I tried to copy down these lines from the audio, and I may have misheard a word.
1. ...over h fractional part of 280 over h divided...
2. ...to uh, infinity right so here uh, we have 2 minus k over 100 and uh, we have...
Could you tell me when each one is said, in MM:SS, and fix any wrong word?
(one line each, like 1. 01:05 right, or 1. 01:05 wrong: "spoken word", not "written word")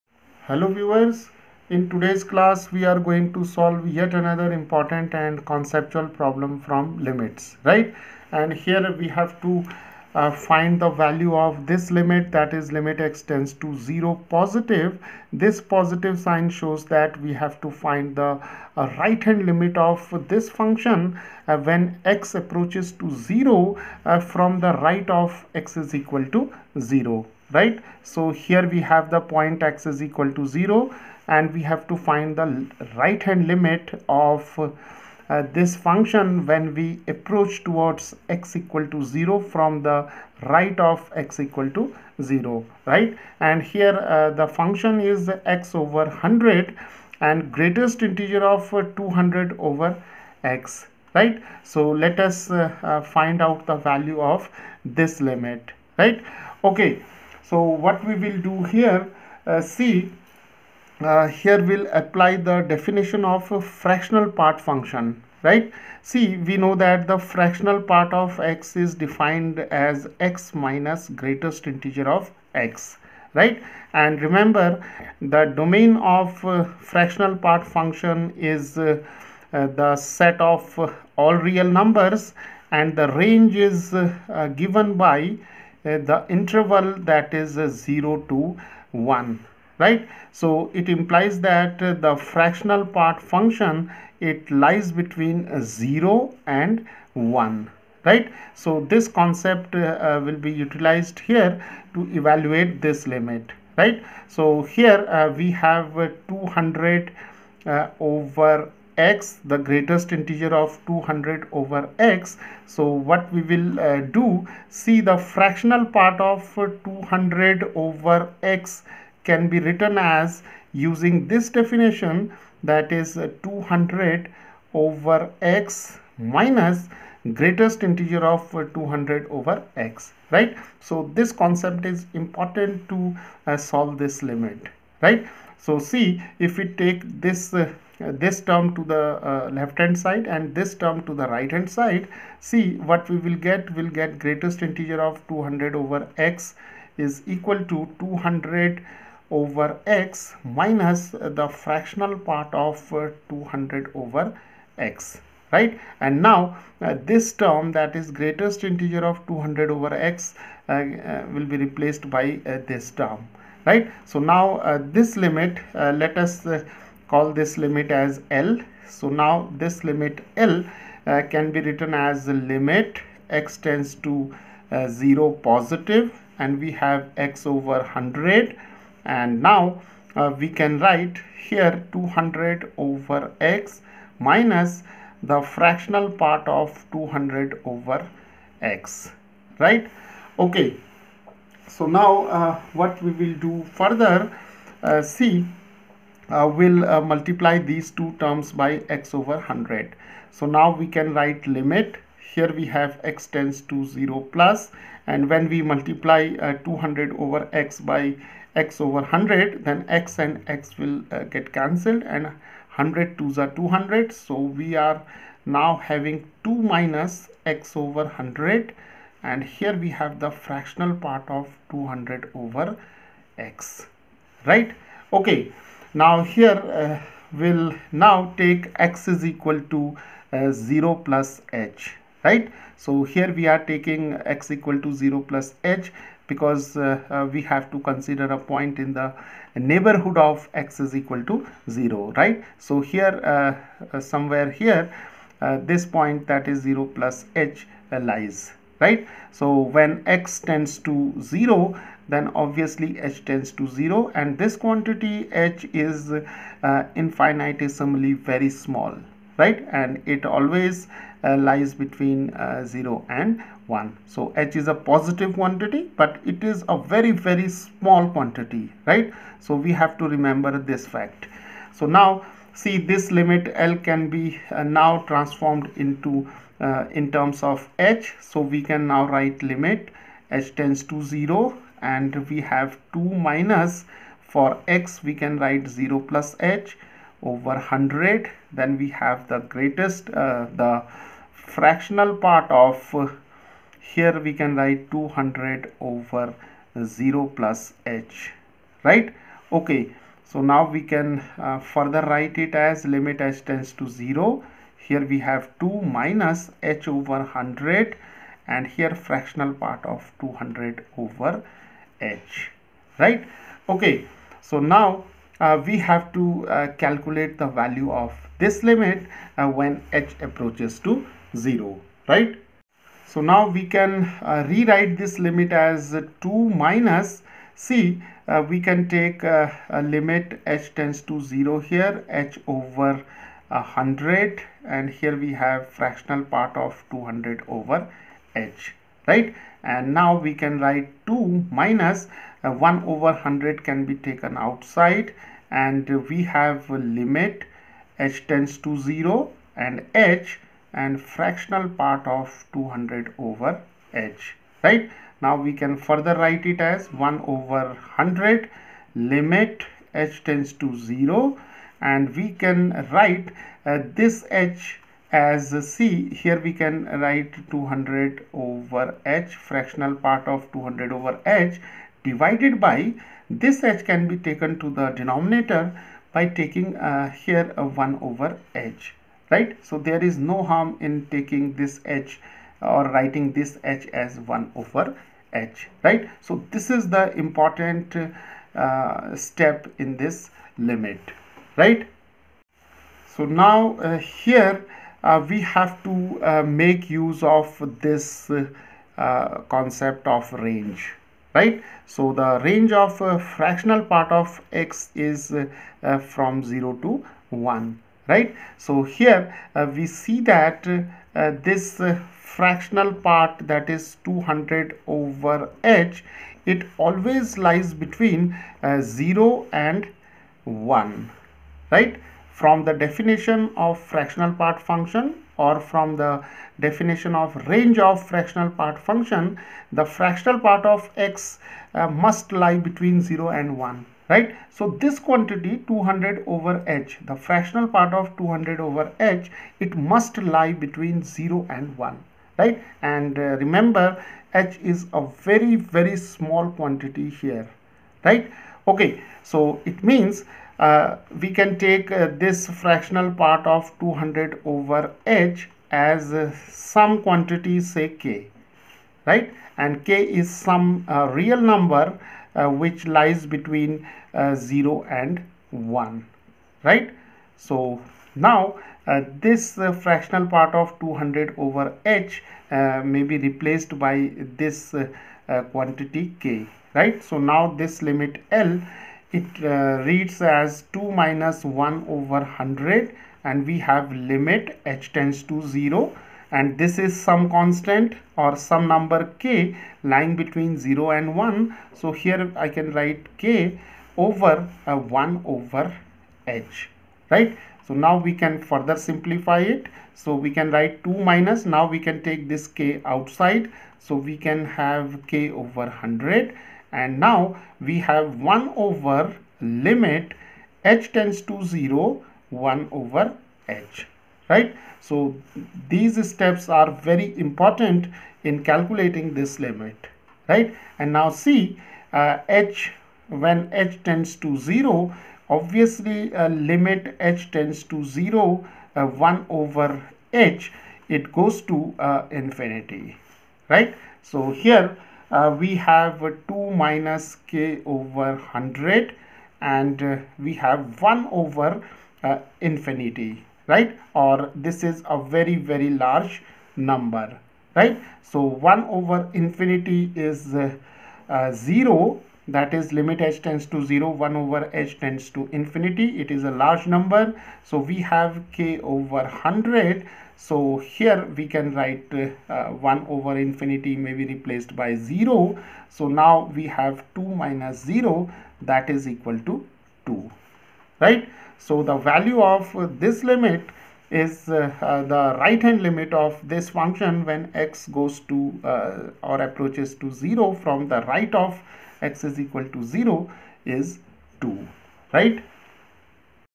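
1. 06:08 wrong: "200", not "280"
2. 08:51 right.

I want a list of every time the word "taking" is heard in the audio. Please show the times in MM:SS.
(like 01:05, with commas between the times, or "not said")
03:53, 06:16, 06:21.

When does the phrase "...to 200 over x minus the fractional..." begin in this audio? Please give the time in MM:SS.
02:27.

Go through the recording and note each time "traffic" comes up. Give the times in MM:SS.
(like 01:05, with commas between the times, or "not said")
not said.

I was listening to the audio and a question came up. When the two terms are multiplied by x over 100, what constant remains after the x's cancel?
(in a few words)
2.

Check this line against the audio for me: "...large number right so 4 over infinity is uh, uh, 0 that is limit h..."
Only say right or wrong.
wrong.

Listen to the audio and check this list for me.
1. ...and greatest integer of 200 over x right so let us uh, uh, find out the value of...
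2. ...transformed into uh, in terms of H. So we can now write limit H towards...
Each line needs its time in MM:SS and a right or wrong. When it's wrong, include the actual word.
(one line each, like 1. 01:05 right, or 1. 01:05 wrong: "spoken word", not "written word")
1. 00:47 right
2. 04:35 wrong: "tends", not "towards".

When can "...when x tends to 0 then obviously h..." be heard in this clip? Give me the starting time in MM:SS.
04:09.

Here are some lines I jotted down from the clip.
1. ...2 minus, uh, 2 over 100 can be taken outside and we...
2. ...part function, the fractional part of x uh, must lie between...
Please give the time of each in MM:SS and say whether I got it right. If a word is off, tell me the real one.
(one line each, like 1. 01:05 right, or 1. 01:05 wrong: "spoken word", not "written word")
1. 05:41 wrong: "1", not "2"
2. 07:08 right.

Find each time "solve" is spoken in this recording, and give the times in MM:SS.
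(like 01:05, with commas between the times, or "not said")
00:03, 02:13.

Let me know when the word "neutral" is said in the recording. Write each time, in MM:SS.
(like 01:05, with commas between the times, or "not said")
not said.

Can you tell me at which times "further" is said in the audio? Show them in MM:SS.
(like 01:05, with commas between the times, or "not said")
03:13, 05:01, 05:55, 08:18.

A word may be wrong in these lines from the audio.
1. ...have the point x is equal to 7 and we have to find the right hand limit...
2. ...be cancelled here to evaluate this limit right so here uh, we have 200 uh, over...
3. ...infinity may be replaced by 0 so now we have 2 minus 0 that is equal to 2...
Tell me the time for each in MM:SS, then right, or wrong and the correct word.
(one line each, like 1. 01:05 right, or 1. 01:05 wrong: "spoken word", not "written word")
1. 00:28 wrong: "0", not "7"
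2. 01:40 wrong: "utilized", not "cancelled"
3. 09:23 right.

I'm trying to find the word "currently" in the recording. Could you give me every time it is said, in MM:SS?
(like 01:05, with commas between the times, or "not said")
not said.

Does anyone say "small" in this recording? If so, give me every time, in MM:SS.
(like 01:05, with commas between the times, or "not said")
04:18, 04:27, 07:26.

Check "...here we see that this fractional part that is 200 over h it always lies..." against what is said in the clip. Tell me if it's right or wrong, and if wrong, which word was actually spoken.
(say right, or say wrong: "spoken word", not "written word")
right.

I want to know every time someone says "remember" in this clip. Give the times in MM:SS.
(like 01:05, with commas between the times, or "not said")
01:14, 04:30, 07:23.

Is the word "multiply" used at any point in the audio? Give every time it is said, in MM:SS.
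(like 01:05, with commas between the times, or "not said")
03:17, 03:25.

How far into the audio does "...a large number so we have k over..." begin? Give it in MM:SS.
09:16.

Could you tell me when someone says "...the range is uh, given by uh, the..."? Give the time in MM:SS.
01:22.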